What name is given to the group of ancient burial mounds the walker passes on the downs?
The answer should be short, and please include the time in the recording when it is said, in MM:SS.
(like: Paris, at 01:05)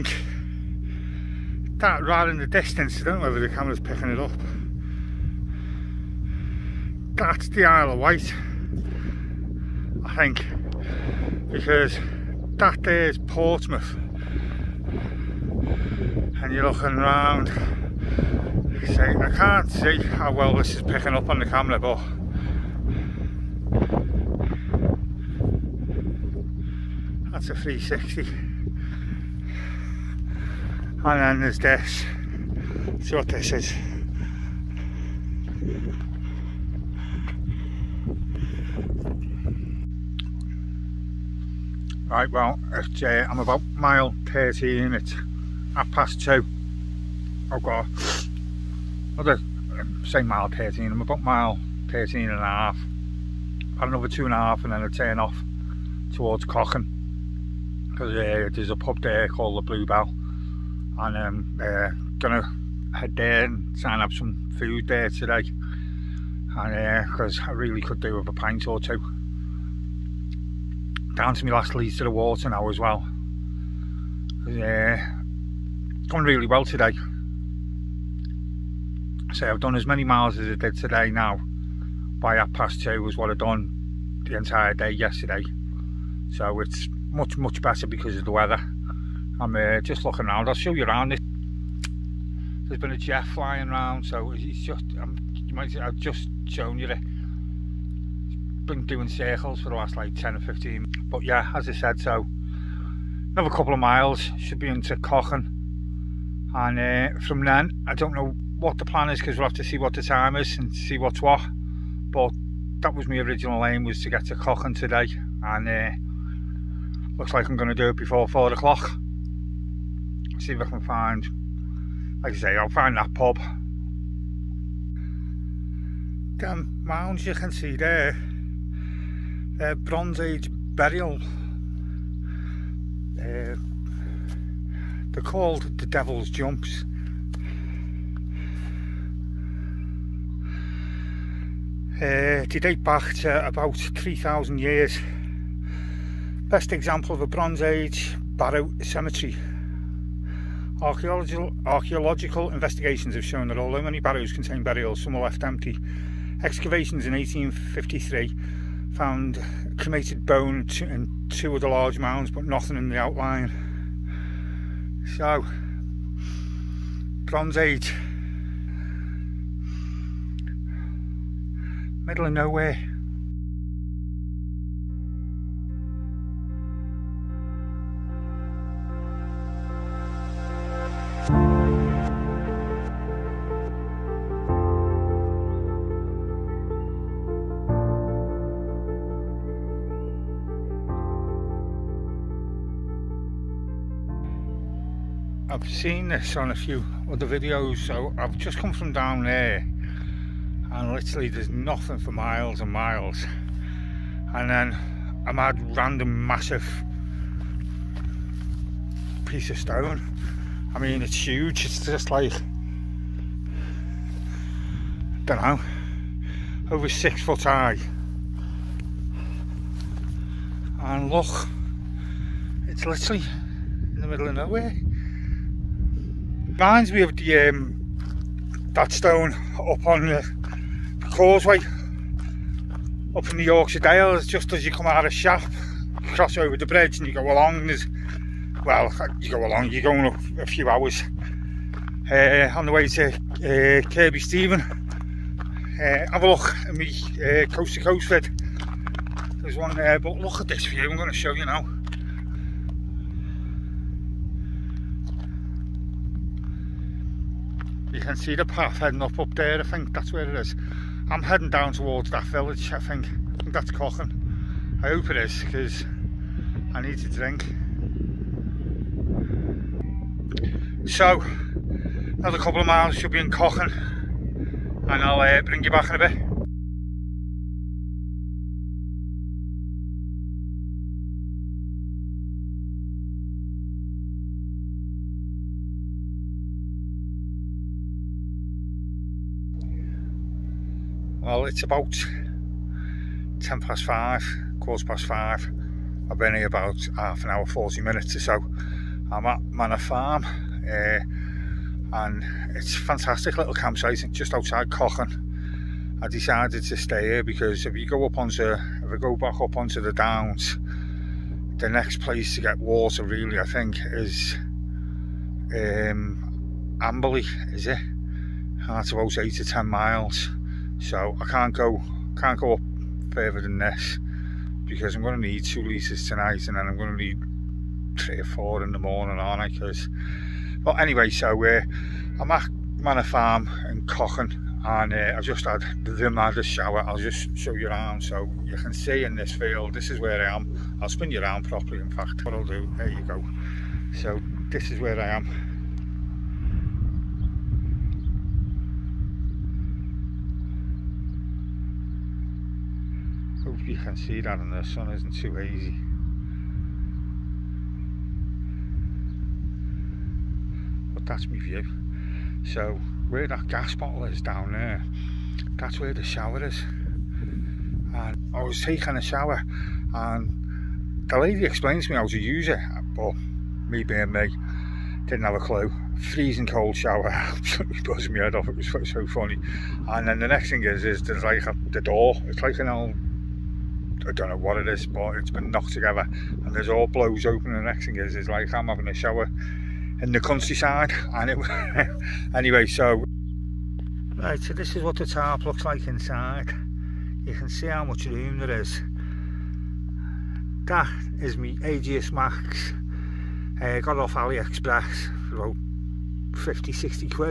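Devil's Jumps, at 02:15.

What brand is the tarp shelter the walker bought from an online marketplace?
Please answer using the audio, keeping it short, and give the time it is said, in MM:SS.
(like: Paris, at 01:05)
Aegismax, at 06:41.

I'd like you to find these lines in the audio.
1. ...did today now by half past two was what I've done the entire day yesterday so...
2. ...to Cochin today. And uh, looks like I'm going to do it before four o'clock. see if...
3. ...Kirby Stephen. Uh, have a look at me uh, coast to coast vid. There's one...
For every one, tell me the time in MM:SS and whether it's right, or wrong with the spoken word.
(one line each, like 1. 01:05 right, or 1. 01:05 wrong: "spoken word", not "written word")
1. 01:20 right
2. 01:54 right
3. 04:03 right.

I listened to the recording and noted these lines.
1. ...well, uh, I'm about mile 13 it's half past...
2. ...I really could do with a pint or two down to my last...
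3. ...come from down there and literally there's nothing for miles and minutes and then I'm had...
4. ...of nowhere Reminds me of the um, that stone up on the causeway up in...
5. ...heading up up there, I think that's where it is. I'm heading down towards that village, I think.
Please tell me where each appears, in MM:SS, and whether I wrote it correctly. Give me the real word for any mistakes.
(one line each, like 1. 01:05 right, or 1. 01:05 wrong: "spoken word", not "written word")
1. 00:42 right
2. 01:07 right
3. 03:18 wrong: "miles", not "minutes"
4. 03:44 right
5. 04:18 right.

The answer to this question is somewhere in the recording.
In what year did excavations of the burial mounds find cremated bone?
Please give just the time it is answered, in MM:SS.
02:37.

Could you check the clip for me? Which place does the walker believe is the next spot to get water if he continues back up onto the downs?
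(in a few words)
Amberley.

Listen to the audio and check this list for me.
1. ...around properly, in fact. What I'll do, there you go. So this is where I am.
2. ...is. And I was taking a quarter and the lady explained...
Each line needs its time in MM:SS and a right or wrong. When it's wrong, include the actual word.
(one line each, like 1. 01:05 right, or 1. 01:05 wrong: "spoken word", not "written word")
1. 05:41 right
2. 06:06 wrong: "shower", not "quarter".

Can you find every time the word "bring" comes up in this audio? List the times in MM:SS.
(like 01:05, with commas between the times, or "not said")
04:35.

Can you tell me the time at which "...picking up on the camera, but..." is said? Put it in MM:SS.
00:20.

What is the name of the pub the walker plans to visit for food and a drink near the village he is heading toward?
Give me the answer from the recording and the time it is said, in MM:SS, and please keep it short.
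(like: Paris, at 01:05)
Blue Bell, at 00:59.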